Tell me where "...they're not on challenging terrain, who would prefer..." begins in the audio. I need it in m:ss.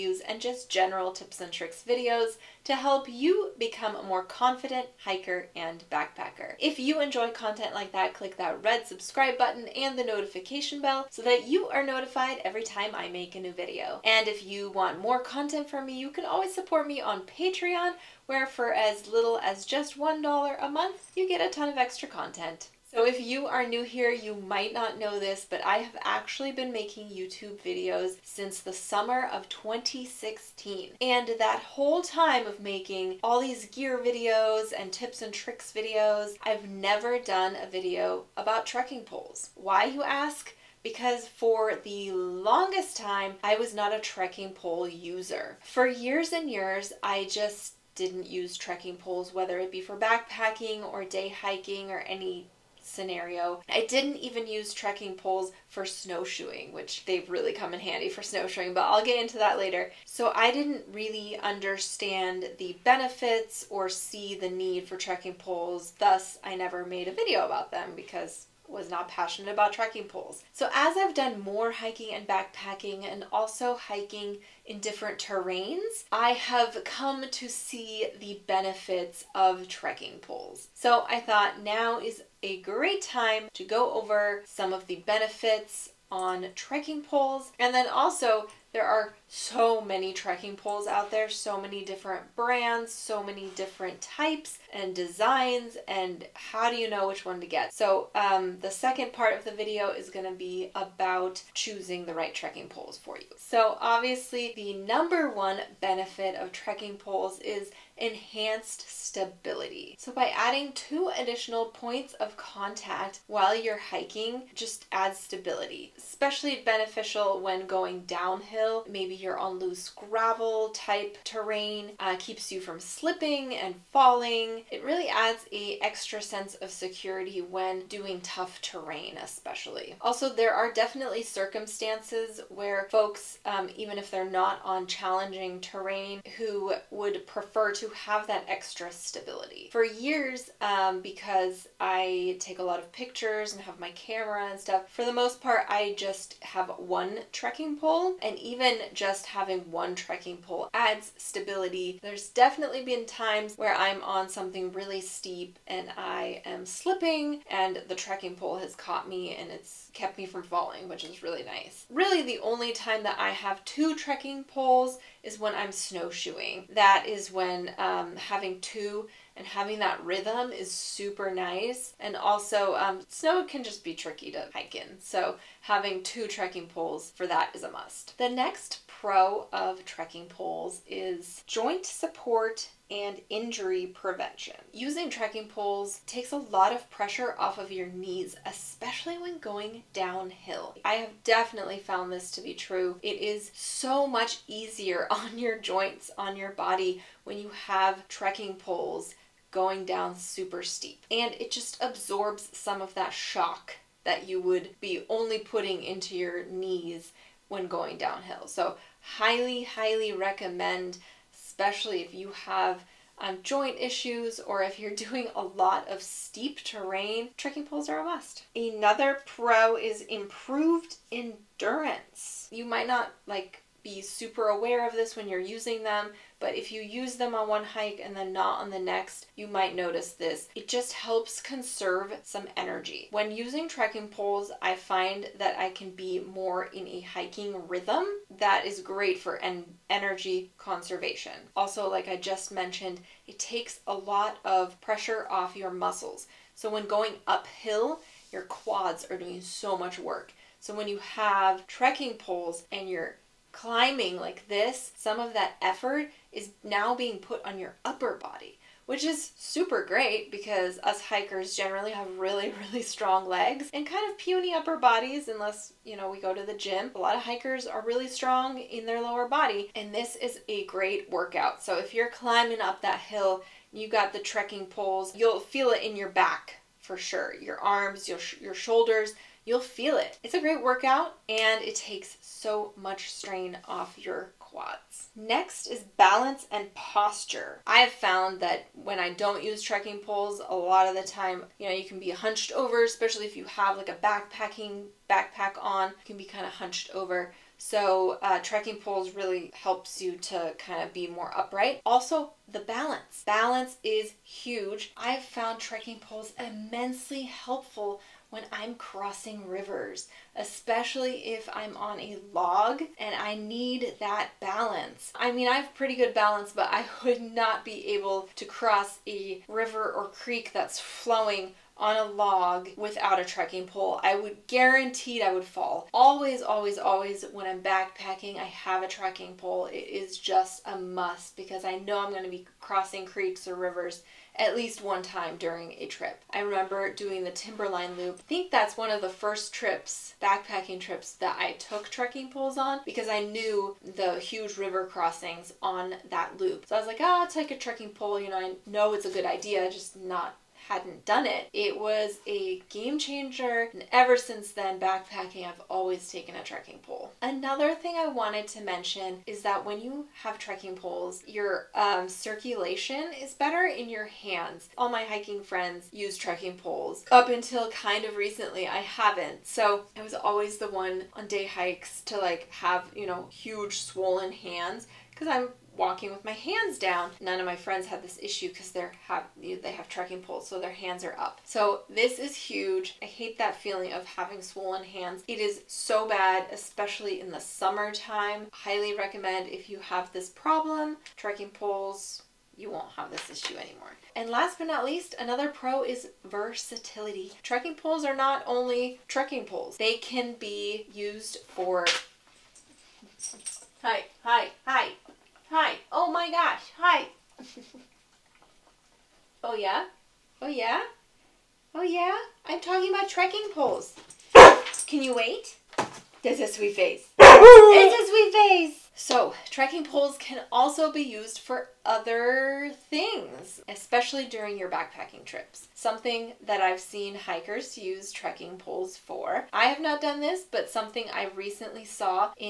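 2:14.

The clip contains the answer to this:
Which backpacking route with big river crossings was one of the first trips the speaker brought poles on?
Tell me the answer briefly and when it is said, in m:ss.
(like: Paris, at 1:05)
Timberline Loop, at 5:37.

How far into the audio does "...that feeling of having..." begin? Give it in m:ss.
6:23.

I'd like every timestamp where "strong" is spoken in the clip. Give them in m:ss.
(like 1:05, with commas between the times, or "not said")
4:22, 4:28.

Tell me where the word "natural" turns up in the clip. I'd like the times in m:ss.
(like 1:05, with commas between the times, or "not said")
not said.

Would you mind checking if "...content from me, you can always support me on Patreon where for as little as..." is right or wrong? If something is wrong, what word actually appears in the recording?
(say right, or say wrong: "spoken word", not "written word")
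right.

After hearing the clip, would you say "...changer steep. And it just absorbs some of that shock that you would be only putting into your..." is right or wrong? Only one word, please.
wrong.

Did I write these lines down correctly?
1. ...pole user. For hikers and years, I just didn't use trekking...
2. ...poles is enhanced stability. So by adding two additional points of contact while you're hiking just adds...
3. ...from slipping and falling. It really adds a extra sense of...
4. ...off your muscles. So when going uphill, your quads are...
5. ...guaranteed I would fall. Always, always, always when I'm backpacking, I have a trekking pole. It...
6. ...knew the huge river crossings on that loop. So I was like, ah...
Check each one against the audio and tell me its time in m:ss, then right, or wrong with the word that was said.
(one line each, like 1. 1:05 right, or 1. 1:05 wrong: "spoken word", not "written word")
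1. 0:44 wrong: "years", not "hikers"
2. 1:46 right
3. 2:02 right
4. 4:05 right
5. 5:24 right
6. 5:43 right.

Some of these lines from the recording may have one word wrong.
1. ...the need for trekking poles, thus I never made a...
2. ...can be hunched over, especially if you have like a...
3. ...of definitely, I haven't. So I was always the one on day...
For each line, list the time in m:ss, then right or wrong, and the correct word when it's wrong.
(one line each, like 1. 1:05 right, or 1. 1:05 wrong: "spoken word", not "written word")
1. 1:04 right
2. 4:51 right
3. 6:08 wrong: "recently", not "definitely".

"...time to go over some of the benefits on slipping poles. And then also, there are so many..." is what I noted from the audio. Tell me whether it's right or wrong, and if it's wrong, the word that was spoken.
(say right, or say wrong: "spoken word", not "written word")
wrong: "trekking", not "slipping".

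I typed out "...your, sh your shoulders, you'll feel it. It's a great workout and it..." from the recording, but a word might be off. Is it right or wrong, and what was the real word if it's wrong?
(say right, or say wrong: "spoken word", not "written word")
right.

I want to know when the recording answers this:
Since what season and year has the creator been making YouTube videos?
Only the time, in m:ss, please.
0:28.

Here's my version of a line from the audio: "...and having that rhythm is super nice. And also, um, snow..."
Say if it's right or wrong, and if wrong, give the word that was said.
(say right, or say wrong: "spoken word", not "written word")
right.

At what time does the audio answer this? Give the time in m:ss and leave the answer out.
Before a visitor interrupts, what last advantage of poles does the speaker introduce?
6:36.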